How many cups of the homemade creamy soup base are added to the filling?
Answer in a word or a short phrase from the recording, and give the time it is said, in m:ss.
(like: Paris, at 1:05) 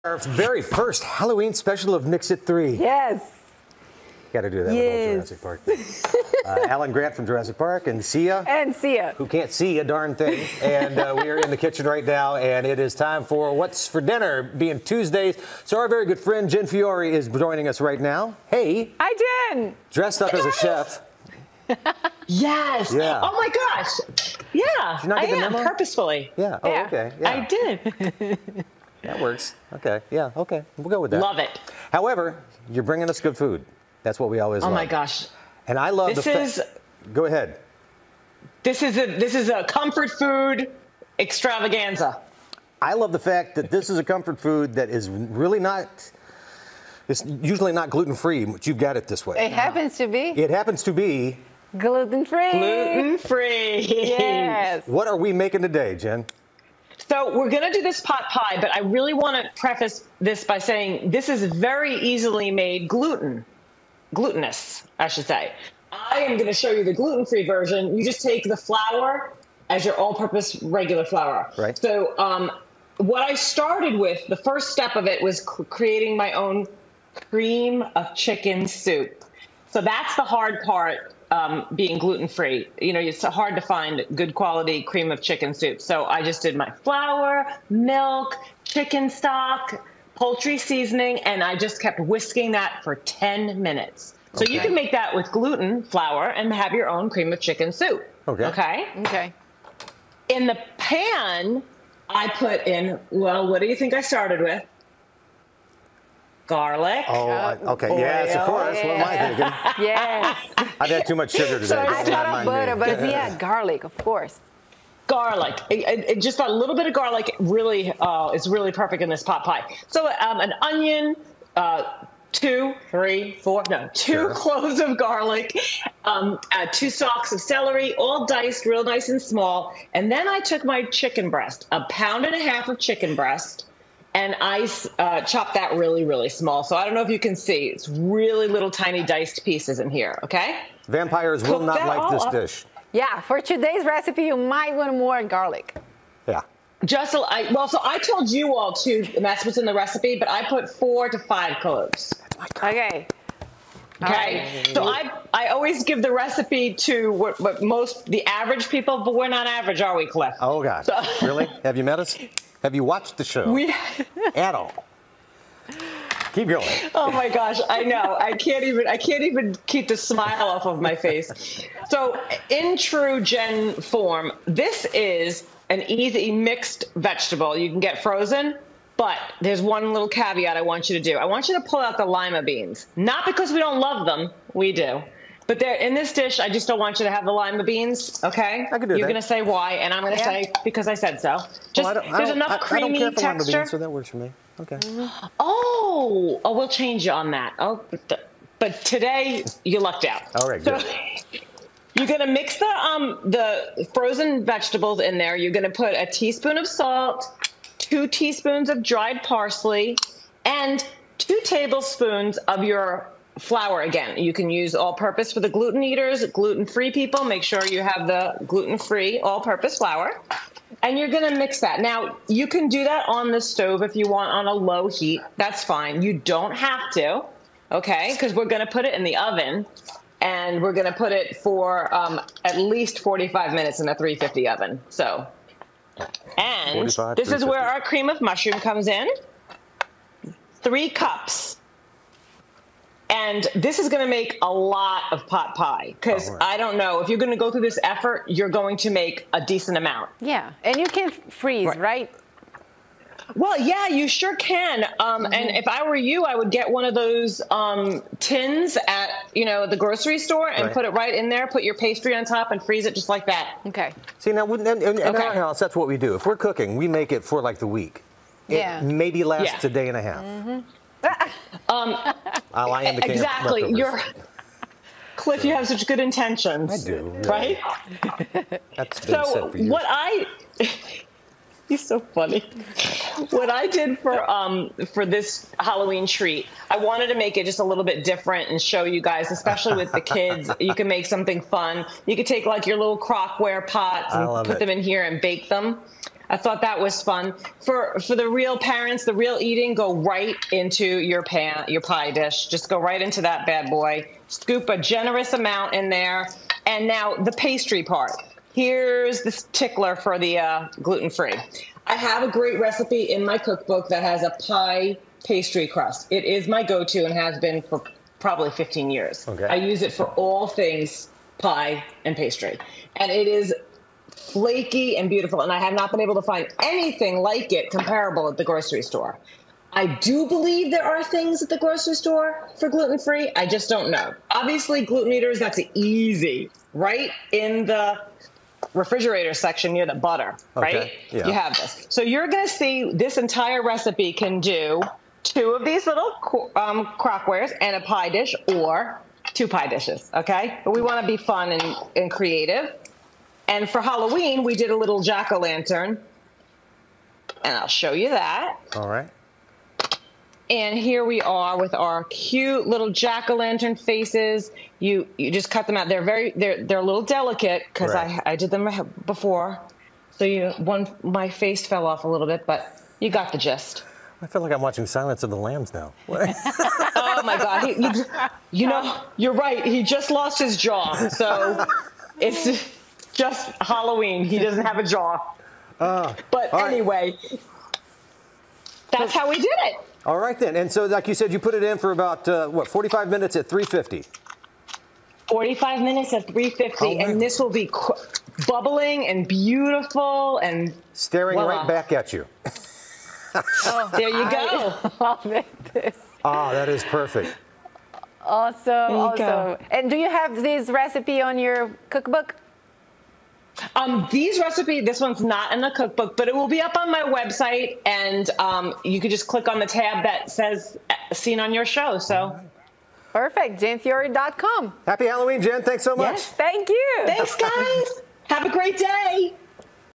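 3 cups, at 4:00.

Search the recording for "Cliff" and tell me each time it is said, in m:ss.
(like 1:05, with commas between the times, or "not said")
2:40, 4:35.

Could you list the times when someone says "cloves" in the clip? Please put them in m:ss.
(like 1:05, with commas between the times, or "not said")
2:04, 2:31.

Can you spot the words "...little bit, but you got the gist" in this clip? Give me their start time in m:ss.
6:12.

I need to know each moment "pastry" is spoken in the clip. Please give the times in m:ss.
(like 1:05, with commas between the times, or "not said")
4:21, 5:07, 5:15, 5:22.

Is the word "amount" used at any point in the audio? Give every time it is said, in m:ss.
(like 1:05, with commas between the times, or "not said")
4:09, 5:05.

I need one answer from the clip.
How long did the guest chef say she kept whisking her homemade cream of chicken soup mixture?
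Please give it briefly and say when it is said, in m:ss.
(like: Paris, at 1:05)
10 minutes, at 1:32.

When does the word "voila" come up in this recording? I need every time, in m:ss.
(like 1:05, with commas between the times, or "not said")
6:41.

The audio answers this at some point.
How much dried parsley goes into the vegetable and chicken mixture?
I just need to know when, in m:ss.
3:27.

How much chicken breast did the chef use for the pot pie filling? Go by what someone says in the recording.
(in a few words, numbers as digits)
A pound and a half.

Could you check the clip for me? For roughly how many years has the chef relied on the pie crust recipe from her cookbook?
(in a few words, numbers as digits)
15 years.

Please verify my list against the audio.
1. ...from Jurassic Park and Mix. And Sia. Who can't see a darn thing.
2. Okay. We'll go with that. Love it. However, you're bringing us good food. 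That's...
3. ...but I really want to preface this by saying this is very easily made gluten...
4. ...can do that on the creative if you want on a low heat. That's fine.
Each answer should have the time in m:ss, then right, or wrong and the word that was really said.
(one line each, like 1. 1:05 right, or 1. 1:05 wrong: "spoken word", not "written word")
1. 0:07 wrong: "Sia", not "Mix"
2. 0:30 right
3. 0:58 right
4. 3:42 wrong: "stove", not "creative".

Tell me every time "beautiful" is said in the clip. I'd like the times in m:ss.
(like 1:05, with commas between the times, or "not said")
5:25, 6:39.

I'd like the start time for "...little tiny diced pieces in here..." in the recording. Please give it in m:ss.
2:18.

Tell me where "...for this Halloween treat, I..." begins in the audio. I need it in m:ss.
4:44.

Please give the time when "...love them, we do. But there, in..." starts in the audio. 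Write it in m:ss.
3:03.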